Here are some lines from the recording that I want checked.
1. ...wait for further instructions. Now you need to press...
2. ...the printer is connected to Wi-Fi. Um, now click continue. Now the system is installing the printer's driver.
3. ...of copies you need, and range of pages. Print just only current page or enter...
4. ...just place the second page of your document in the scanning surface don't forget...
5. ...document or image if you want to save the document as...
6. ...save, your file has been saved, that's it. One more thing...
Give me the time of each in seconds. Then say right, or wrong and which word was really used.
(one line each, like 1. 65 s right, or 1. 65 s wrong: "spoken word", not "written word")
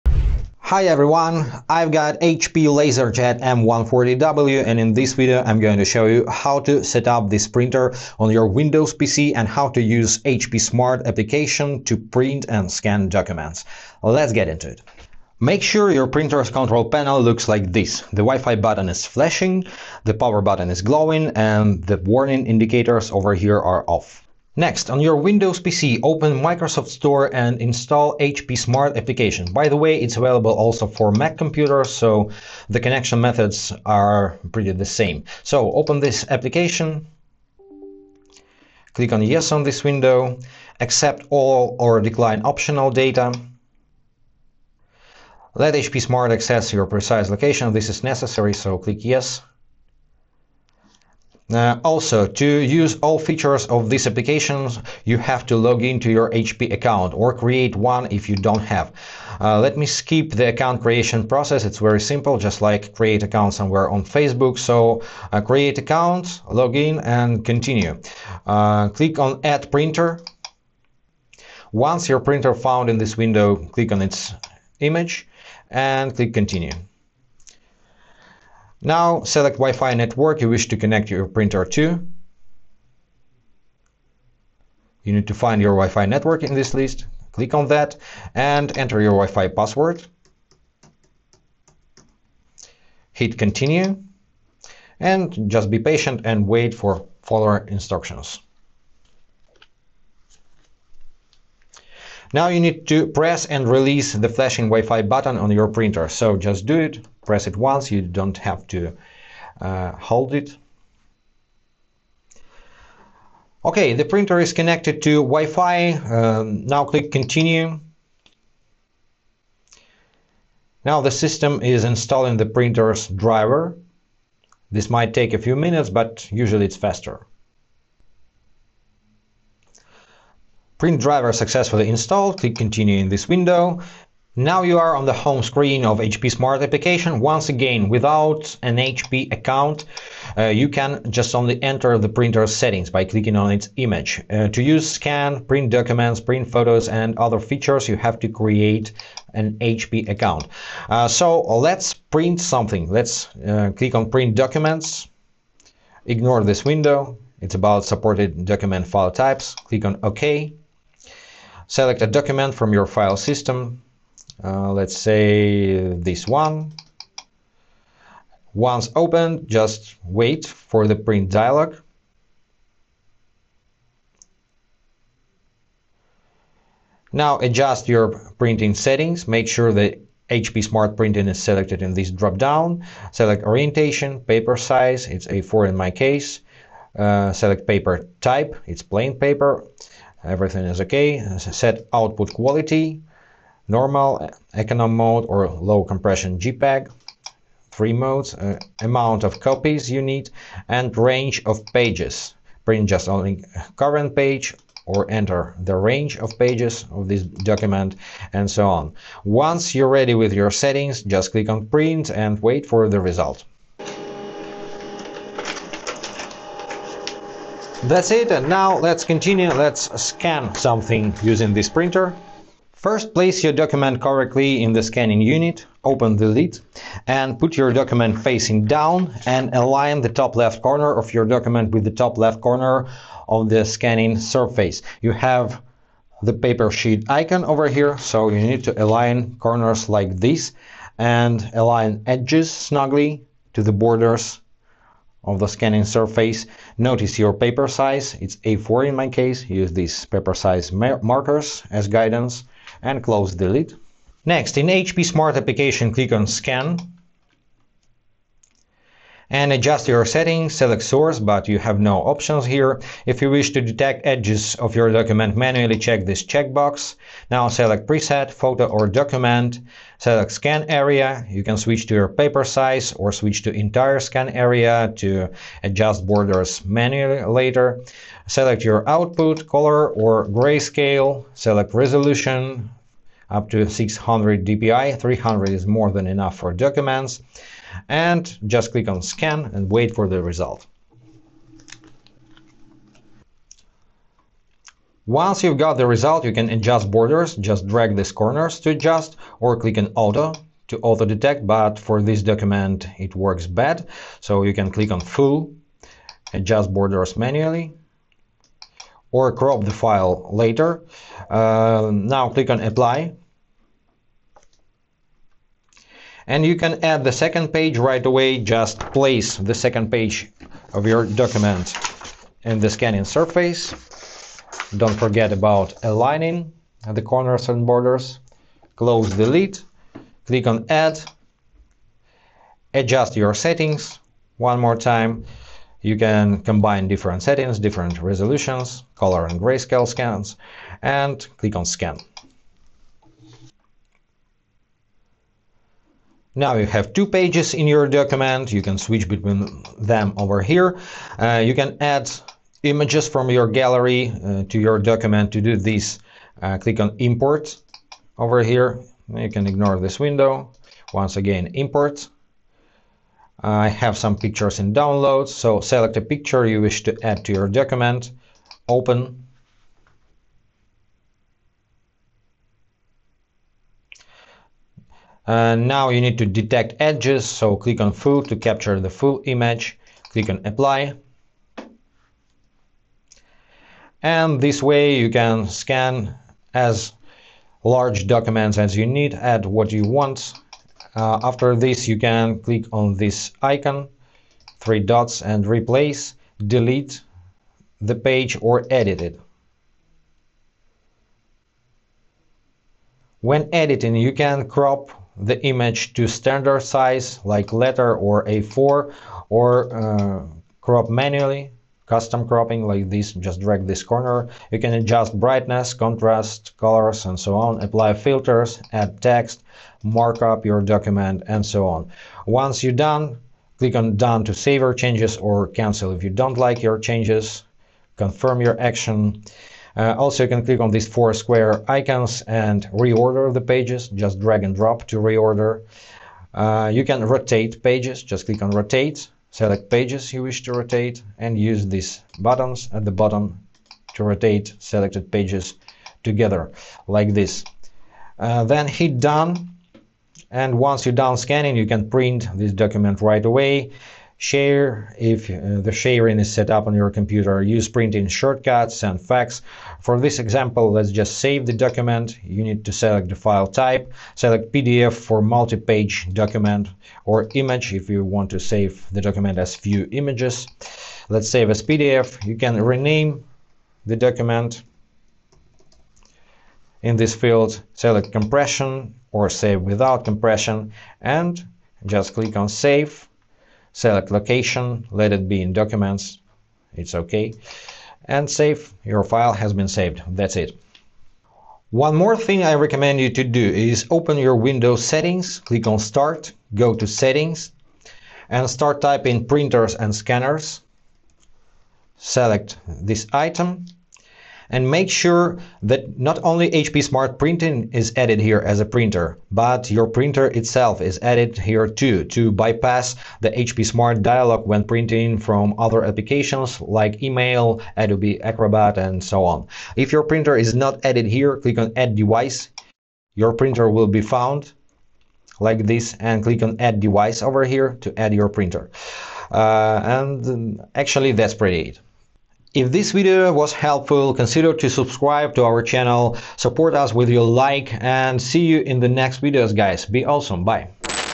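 1. 96 s right
2. 113 s right
3. 199 s right
4. 318 s right
5. 466 s right
6. 488 s right.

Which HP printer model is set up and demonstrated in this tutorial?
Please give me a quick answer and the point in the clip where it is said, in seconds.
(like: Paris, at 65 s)
LaserJet M140W, at 2 s.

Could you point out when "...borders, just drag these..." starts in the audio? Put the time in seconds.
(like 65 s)
296 s.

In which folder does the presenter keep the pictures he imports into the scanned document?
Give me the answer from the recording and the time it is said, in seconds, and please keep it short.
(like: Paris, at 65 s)
downloads, at 364 s.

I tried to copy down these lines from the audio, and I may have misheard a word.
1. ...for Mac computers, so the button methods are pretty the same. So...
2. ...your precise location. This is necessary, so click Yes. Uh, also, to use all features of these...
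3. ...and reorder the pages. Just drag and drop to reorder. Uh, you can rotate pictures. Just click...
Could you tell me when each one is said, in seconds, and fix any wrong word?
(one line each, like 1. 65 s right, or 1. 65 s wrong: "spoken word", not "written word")
1. 30 s wrong: "connection", not "button"
2. 46 s right
3. 432 s wrong: "pages", not "pictures".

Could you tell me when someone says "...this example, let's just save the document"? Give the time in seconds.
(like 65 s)
459 s.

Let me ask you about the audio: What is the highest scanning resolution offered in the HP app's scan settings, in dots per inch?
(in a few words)
600 dpi.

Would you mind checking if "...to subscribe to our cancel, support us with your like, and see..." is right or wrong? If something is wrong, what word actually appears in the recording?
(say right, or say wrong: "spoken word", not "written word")
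wrong: "channel", not "cancel".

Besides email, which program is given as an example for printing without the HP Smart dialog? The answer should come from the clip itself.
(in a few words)
Adobe Acrobat.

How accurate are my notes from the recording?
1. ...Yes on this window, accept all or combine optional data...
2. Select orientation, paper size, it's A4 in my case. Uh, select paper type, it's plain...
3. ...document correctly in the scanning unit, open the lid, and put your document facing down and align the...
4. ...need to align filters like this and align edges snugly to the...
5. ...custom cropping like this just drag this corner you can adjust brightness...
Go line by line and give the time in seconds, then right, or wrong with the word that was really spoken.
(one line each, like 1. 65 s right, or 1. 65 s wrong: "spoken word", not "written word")
1. 39 s wrong: "decline", not "combine"
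2. 183 s right
3. 223 s right
4. 238 s wrong: "corners", not "filters"
5. 411 s right.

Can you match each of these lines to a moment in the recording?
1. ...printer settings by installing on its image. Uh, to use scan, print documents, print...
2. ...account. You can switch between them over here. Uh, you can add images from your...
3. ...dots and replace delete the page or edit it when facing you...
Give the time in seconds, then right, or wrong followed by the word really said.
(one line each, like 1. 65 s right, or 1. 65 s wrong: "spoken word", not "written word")
1. 142 s wrong: "clicking", not "installing"
2. 347 s wrong: "document", not "account"
3. 394 s wrong: "editing", not "facing".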